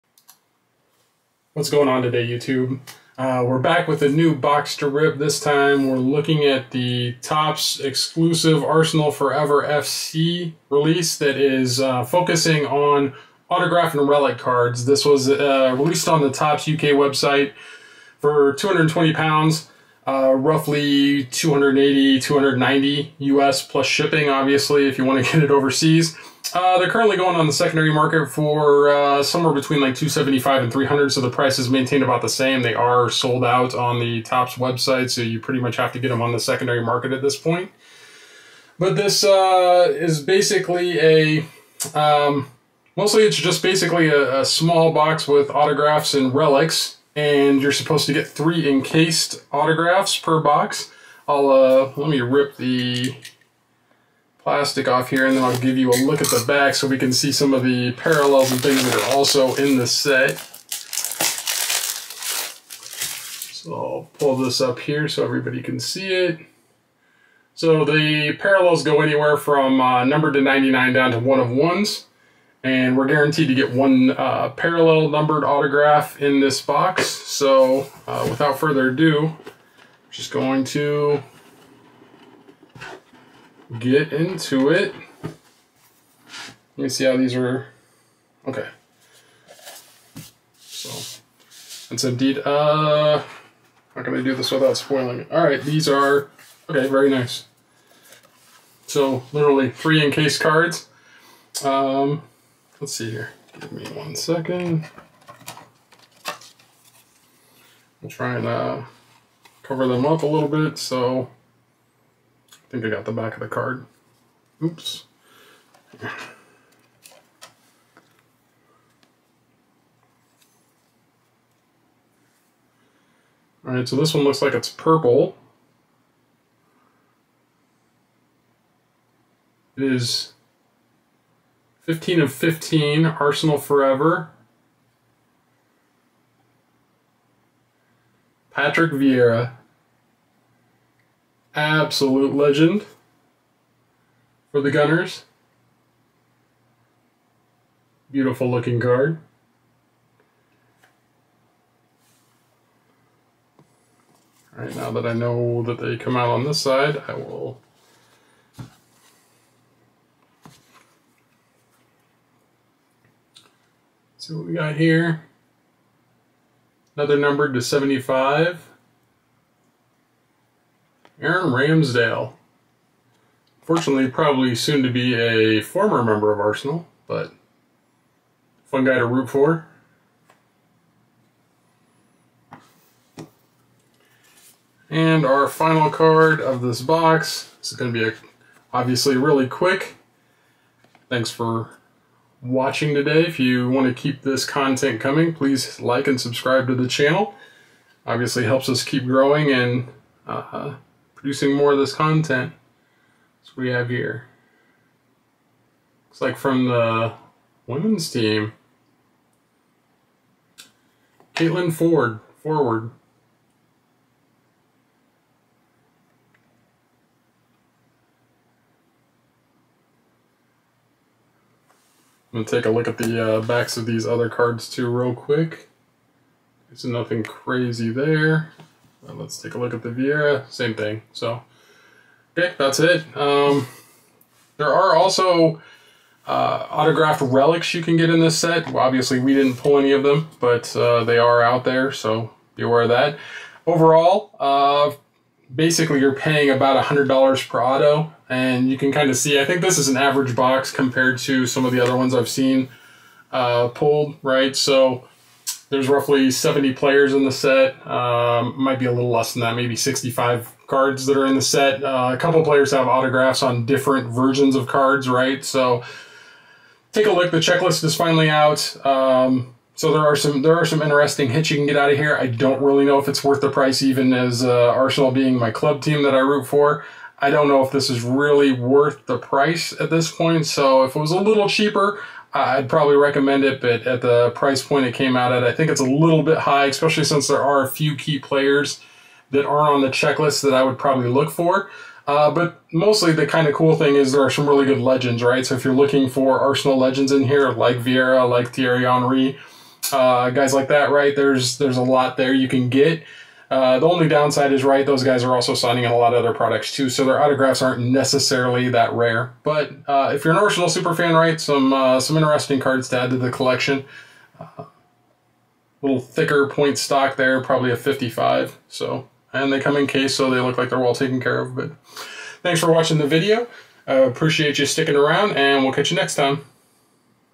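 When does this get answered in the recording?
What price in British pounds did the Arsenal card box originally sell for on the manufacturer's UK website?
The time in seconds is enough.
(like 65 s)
18 s.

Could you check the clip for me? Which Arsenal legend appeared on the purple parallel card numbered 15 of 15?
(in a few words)
Patrick Vieira.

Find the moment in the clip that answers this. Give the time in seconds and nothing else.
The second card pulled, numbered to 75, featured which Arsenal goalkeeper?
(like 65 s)
171 s.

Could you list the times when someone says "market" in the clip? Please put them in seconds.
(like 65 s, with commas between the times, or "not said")
27 s, 36 s.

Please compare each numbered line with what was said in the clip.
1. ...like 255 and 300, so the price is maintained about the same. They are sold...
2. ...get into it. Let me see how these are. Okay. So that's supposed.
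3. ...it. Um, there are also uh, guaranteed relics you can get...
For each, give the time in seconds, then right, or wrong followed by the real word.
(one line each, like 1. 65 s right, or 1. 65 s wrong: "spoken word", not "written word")
1. 29 s wrong: "275", not "255"
2. 83 s wrong: "indeed", not "supposed"
3. 232 s wrong: "autographed", not "guaranteed".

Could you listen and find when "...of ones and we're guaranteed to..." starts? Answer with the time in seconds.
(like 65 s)
71 s.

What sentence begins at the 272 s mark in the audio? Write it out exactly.
I don't really know if it's worth the price, even as uh, Arsenal being my club team that I root for.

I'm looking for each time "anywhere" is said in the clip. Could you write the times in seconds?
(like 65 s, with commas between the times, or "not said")
69 s.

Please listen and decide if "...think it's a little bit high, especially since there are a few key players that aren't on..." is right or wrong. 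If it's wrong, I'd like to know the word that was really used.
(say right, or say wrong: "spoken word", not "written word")
right.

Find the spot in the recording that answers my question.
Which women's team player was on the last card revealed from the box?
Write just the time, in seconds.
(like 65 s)
211 s.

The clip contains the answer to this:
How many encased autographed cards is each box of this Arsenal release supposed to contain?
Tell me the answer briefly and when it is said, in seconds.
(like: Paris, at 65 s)
3, at 48 s.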